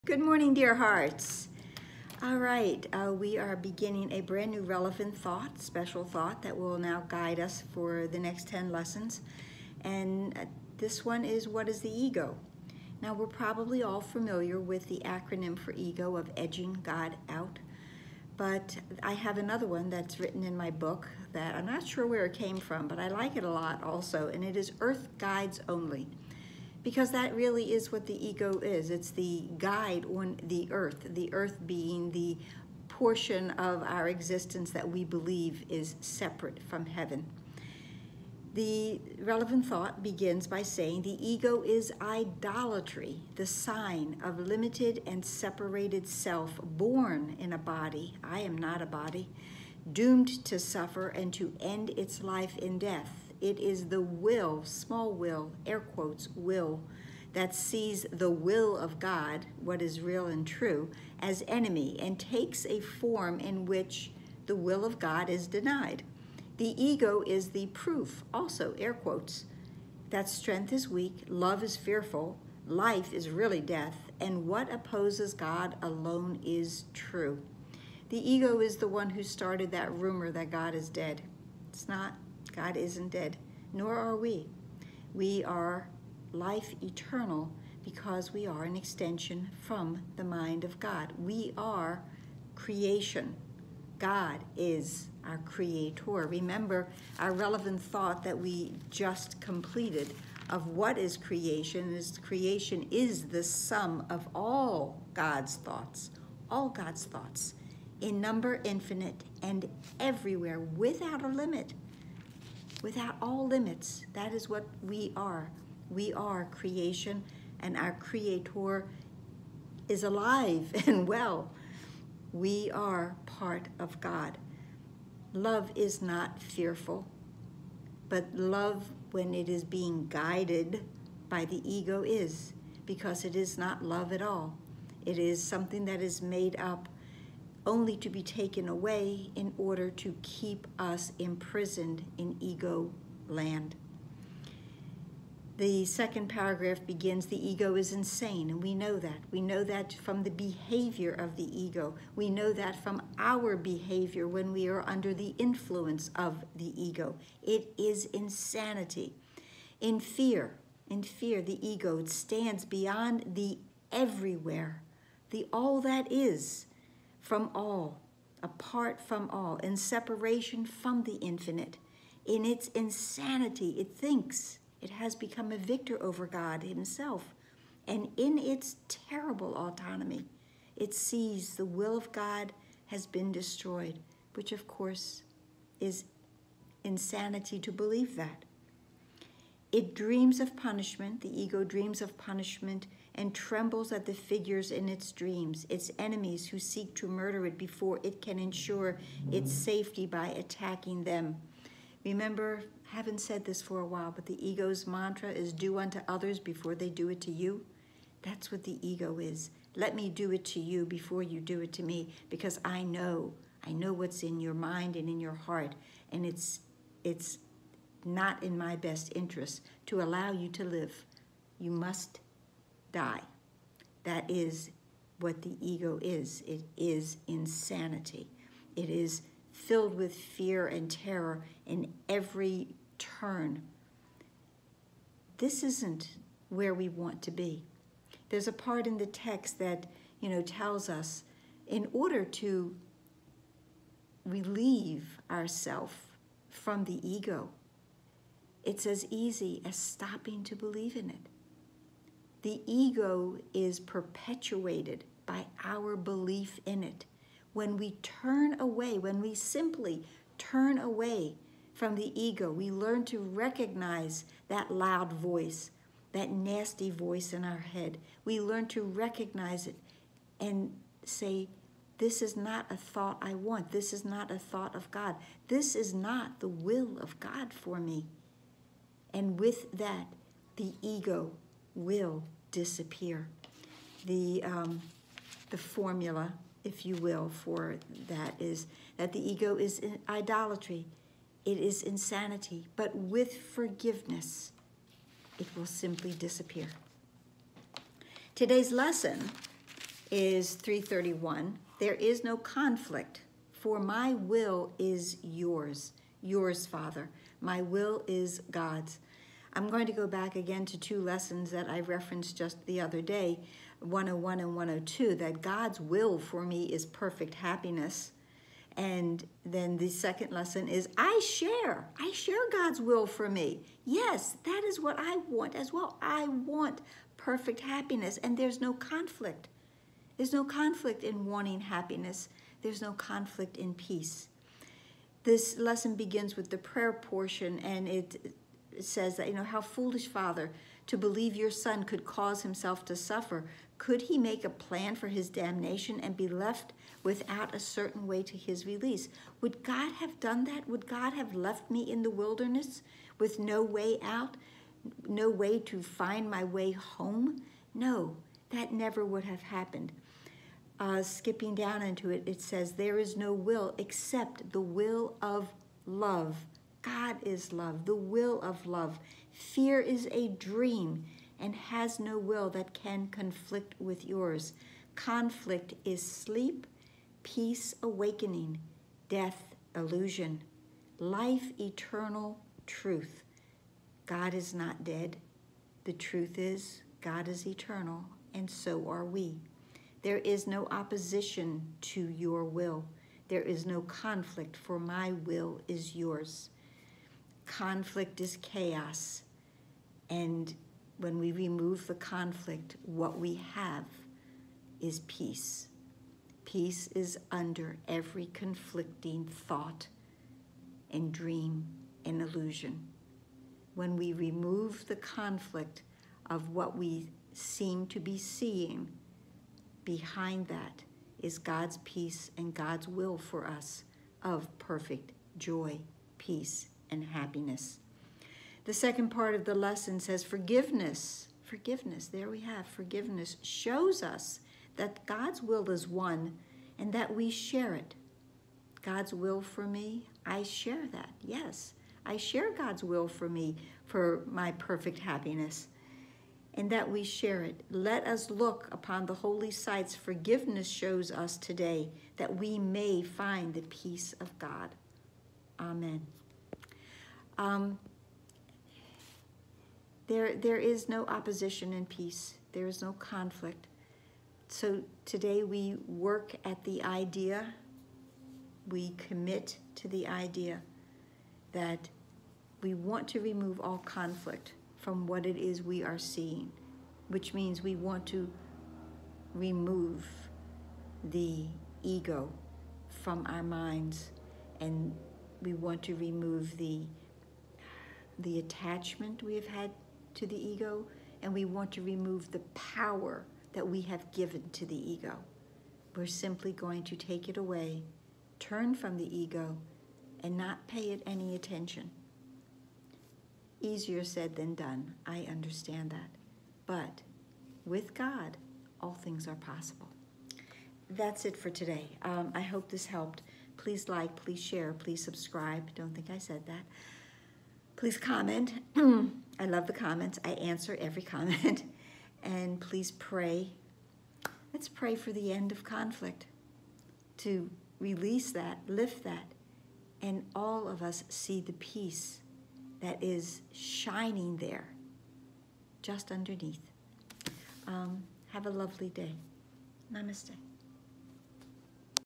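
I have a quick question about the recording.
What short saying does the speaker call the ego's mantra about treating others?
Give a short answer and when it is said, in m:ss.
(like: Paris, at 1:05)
do unto others before they do it to you, at 3:25.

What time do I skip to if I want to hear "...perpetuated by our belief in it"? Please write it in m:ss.
4:13.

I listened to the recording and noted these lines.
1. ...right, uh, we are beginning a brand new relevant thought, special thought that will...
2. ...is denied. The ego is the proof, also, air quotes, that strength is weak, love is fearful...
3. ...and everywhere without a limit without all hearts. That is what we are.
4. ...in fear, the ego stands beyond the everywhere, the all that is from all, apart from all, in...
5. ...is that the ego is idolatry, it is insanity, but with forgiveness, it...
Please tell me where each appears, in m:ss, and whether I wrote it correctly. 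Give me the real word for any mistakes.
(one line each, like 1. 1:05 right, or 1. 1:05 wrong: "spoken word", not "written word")
1. 0:02 right
2. 1:05 right
3. 1:49 wrong: "limits", not "hearts"
4. 2:40 right
5. 4:48 right.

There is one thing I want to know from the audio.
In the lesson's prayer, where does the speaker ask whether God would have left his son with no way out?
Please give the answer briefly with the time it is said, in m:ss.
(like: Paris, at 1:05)
in the wilderness, at 5:51.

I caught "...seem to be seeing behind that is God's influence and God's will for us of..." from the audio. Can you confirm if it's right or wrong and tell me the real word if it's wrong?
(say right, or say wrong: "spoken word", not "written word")
wrong: "peace", not "influence".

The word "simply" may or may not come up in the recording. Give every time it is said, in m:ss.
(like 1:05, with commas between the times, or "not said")
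4:19, 4:55, 8:16.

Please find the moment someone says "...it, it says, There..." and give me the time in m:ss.
6:02.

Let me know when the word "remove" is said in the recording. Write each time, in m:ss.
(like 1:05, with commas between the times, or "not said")
6:41, 6:54, 7:53, 7:59, 8:05, 8:11.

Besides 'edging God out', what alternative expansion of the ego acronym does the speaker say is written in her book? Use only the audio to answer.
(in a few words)
Earth Guides Only.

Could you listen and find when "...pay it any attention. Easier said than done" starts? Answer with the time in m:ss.
8:20.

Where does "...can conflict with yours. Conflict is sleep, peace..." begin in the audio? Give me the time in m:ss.
6:12.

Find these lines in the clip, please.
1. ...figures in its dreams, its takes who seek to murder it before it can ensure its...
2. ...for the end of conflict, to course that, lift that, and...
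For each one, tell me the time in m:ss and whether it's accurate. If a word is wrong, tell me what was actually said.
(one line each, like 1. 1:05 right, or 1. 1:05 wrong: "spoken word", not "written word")
1. 3:14 wrong: "enemies", not "takes"
2. 8:44 wrong: "release", not "course".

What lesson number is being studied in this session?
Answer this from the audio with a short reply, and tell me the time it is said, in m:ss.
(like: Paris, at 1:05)
331, at 5:00.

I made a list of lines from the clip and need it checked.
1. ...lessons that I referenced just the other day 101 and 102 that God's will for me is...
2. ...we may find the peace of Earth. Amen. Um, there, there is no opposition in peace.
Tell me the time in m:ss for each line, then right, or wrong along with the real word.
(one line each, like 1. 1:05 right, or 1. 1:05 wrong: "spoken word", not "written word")
1. 5:11 right
2. 7:32 wrong: "God", not "Earth".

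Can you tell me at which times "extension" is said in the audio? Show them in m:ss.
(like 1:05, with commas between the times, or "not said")
1:28.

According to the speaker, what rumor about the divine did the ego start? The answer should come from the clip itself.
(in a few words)
God is dead.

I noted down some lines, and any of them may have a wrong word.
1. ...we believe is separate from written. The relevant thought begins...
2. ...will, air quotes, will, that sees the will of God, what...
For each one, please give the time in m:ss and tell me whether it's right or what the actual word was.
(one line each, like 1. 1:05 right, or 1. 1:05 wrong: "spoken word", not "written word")
1. 0:34 wrong: "heaven", not "written"
2. 0:55 right.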